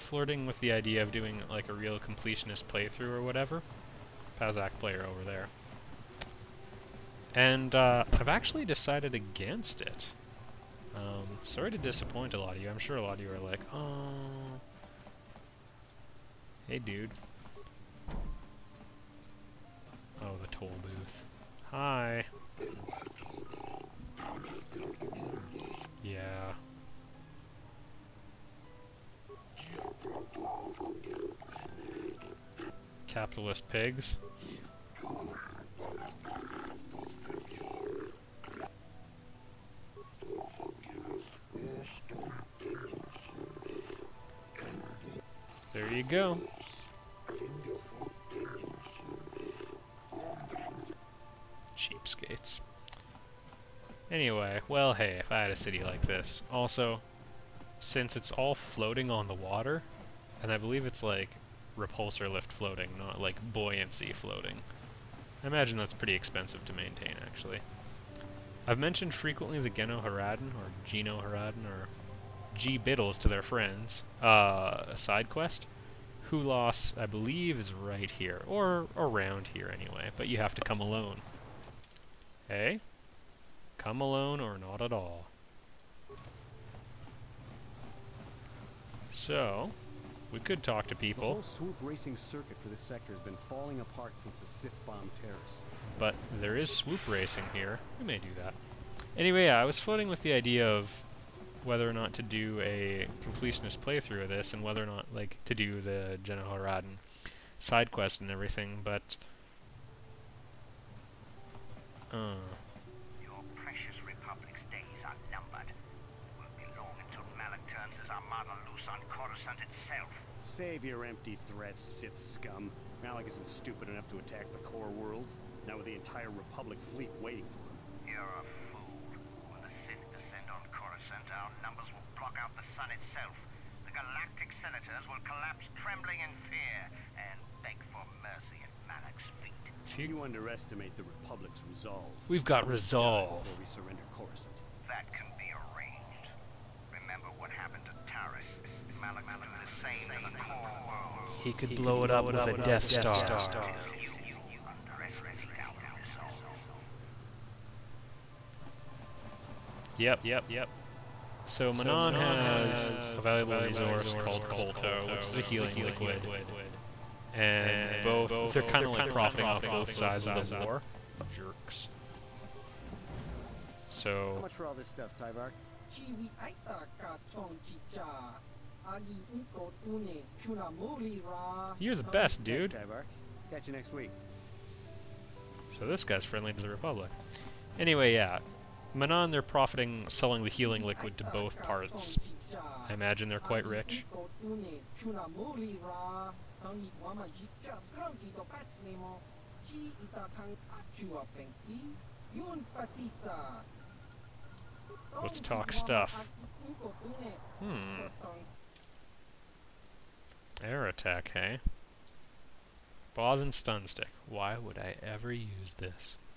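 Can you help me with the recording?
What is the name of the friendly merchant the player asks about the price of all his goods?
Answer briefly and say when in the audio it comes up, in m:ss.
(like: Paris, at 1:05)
Tybar, at 2:55.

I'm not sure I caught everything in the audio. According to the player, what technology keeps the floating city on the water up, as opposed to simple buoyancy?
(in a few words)
Repulsor lift.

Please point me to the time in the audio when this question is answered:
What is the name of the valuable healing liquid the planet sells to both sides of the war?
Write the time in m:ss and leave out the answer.
2:44.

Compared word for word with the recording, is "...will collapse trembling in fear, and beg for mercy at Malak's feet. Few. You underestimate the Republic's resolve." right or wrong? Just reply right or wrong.
right.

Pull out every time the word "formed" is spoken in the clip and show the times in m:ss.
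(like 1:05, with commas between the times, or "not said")
not said.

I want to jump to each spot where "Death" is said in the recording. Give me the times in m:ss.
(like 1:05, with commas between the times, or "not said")
2:32.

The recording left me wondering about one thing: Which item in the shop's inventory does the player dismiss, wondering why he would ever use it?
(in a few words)
Bothan stun stick.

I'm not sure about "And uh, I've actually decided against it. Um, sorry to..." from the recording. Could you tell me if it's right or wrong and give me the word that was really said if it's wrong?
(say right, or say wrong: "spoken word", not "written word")
right.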